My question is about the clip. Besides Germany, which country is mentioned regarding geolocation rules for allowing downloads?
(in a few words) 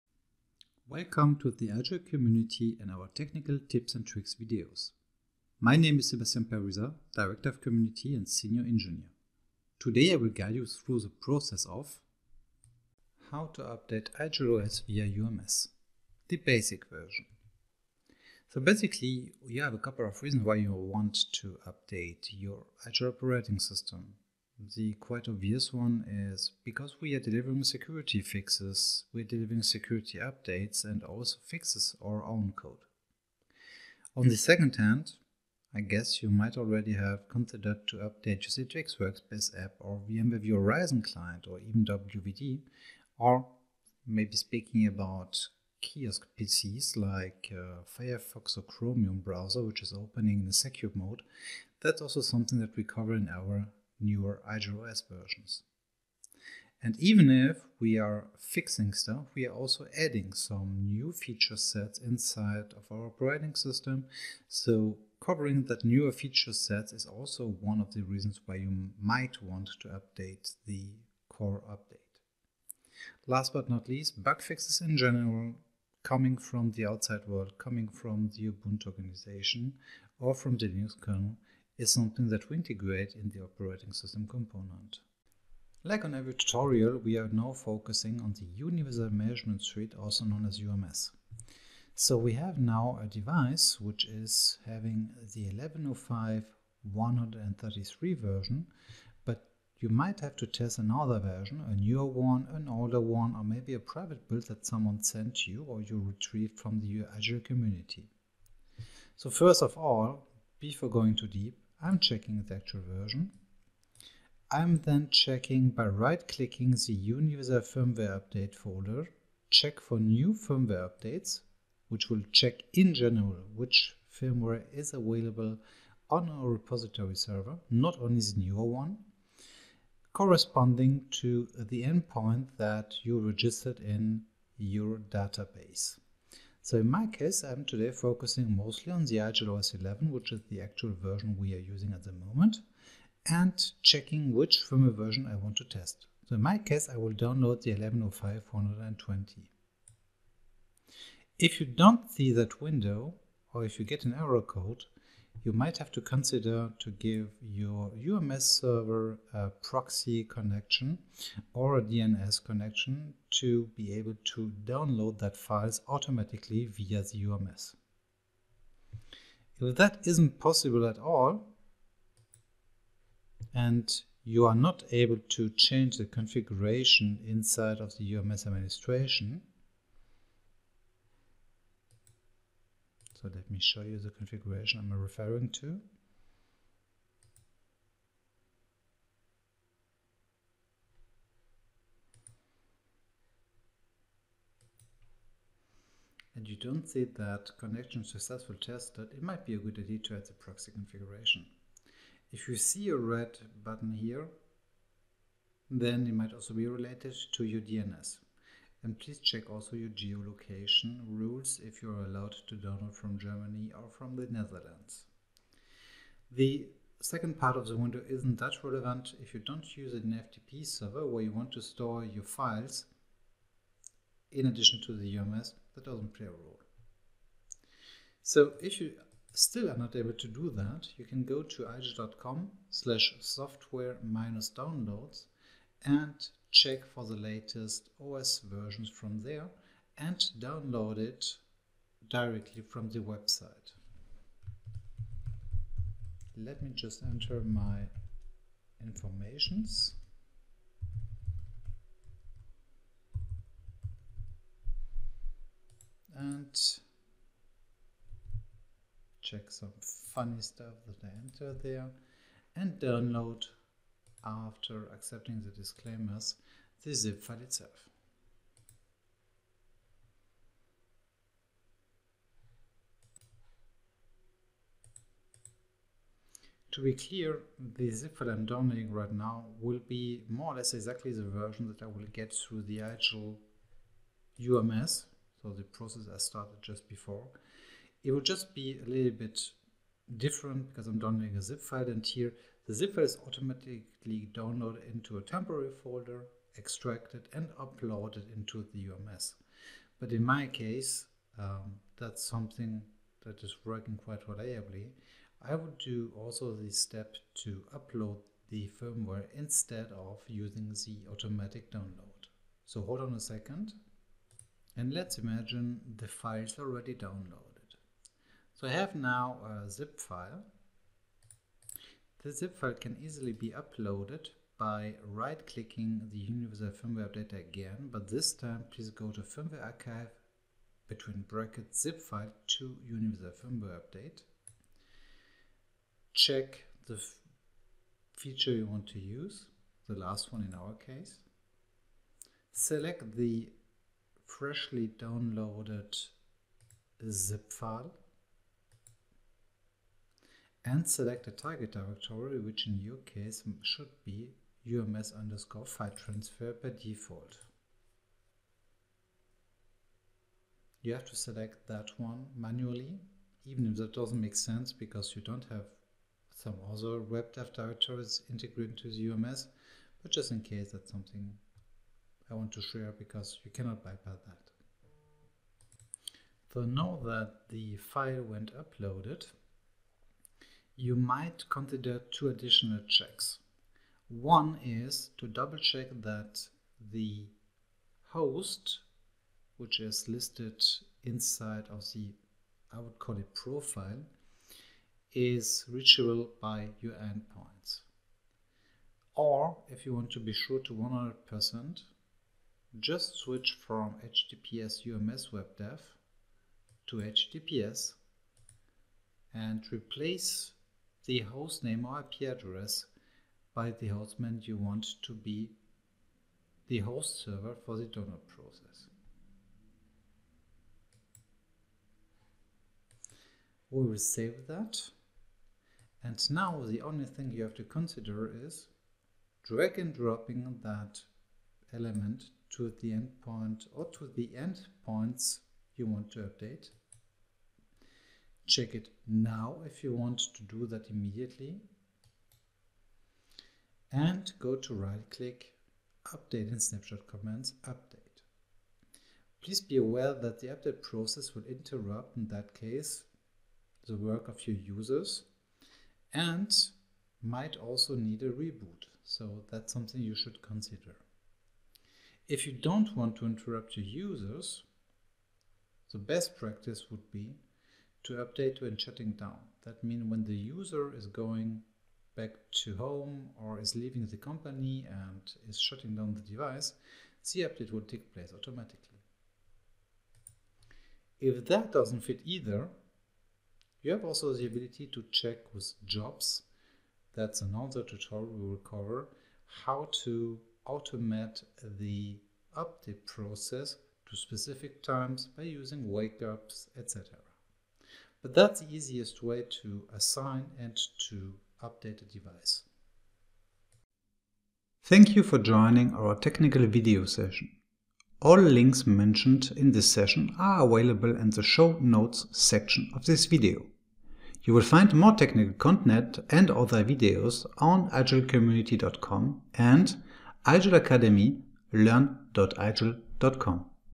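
the Netherlands.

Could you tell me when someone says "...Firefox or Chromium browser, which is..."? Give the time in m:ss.
0:47.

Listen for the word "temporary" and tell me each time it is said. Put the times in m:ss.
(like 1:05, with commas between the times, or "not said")
4:55.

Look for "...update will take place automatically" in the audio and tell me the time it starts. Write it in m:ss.
7:57.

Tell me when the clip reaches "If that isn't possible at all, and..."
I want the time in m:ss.
2:49.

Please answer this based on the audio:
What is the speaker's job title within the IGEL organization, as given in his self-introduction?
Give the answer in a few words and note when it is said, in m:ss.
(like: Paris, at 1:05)
Director of Community, at 0:07.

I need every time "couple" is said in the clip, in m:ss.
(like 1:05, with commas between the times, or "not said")
0:19.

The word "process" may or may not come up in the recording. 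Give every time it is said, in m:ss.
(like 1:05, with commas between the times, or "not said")
0:11, 4:45, 6:58, 7:30, 8:13.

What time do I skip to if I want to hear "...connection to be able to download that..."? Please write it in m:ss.
2:42.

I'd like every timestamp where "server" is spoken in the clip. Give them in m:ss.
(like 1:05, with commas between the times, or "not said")
2:07, 2:38, 3:40, 6:57.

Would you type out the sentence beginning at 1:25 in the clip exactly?
Like on every tutorial, we are now focusing on the Universal Management Suite, also known as UMS.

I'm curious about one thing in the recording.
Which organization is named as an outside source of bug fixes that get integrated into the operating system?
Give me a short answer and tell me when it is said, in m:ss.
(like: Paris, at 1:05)
Ubuntu, at 1:18.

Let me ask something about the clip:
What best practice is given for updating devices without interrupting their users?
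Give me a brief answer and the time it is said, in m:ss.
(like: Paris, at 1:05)
Update when shutting down, at 7:48.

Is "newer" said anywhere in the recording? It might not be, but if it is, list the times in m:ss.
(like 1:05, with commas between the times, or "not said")
0:54, 1:05, 1:41, 2:08.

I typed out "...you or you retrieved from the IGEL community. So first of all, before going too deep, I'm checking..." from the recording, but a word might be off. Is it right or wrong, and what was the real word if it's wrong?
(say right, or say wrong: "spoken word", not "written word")
right.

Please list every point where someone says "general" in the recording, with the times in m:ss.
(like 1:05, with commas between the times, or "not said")
1:14, 2:02.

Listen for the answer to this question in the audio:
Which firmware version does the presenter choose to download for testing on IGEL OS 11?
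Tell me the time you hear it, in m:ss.
2:27.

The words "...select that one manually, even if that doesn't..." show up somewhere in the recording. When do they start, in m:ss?
6:01.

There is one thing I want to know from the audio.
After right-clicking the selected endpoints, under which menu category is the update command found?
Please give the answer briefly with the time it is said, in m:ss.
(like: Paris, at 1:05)
Update and snapshot commands, at 7:26.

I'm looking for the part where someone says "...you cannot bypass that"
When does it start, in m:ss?
6:13.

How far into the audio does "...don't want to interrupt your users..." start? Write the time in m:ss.
7:42.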